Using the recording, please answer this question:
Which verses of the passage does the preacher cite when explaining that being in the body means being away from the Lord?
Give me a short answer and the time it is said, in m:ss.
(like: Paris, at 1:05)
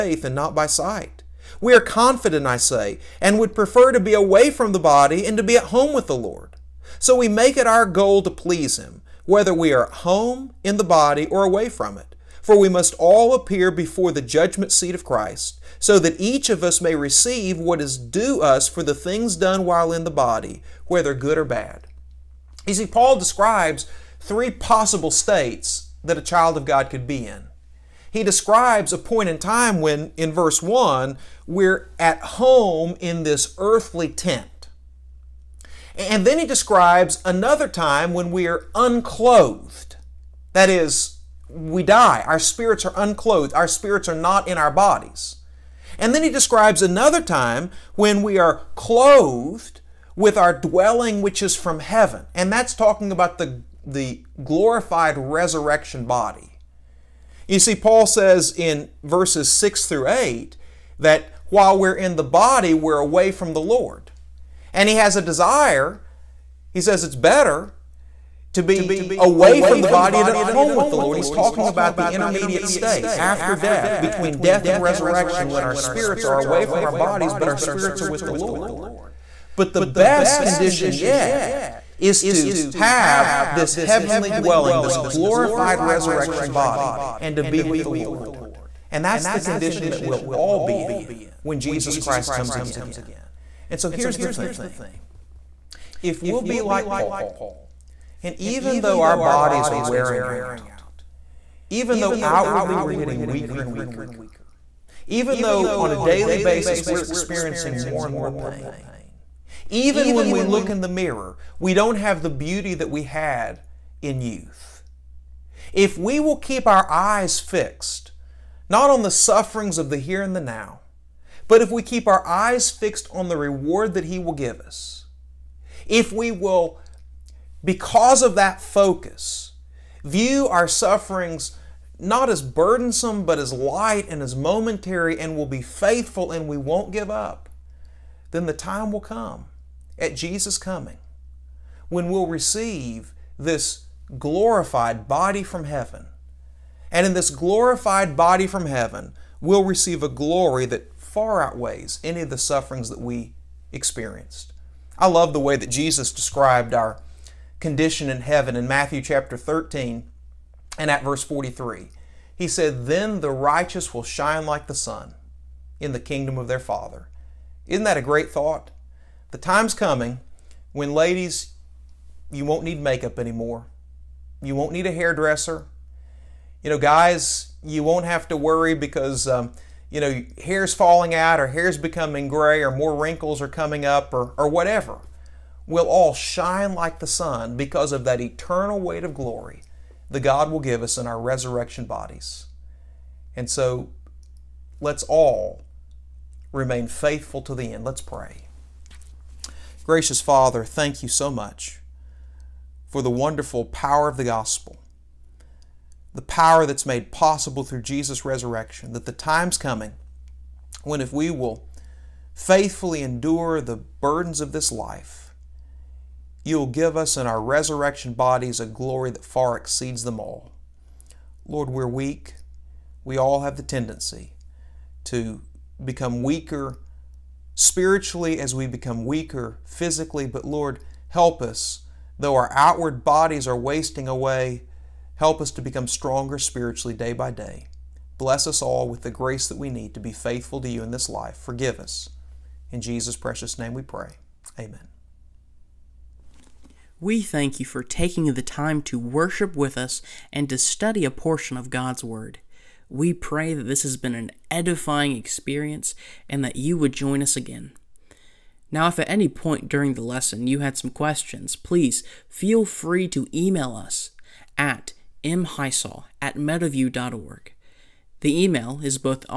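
6 through 8, at 0:59.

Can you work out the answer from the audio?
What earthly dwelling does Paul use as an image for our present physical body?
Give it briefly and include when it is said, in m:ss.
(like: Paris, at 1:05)
earthly tent, at 0:33.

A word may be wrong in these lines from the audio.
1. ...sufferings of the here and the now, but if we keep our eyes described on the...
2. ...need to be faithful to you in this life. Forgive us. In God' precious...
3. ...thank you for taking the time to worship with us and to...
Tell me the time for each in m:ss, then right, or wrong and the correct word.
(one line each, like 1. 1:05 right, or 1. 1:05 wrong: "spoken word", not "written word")
1. 1:59 wrong: "fixed", not "described"
2. 3:59 wrong: "Jesus", not "God"
3. 4:07 right.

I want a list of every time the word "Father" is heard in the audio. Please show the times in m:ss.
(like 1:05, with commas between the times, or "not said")
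2:46, 3:20.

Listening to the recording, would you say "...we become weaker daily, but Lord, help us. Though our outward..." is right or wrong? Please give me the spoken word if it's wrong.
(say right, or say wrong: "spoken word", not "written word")
wrong: "physically", not "daily".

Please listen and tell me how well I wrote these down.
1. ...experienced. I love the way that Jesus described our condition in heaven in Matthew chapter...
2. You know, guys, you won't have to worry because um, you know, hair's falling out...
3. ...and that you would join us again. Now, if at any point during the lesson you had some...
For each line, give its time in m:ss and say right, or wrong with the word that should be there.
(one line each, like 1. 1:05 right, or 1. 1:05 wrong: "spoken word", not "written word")
1. 2:33 right
2. 2:56 right
3. 4:16 right.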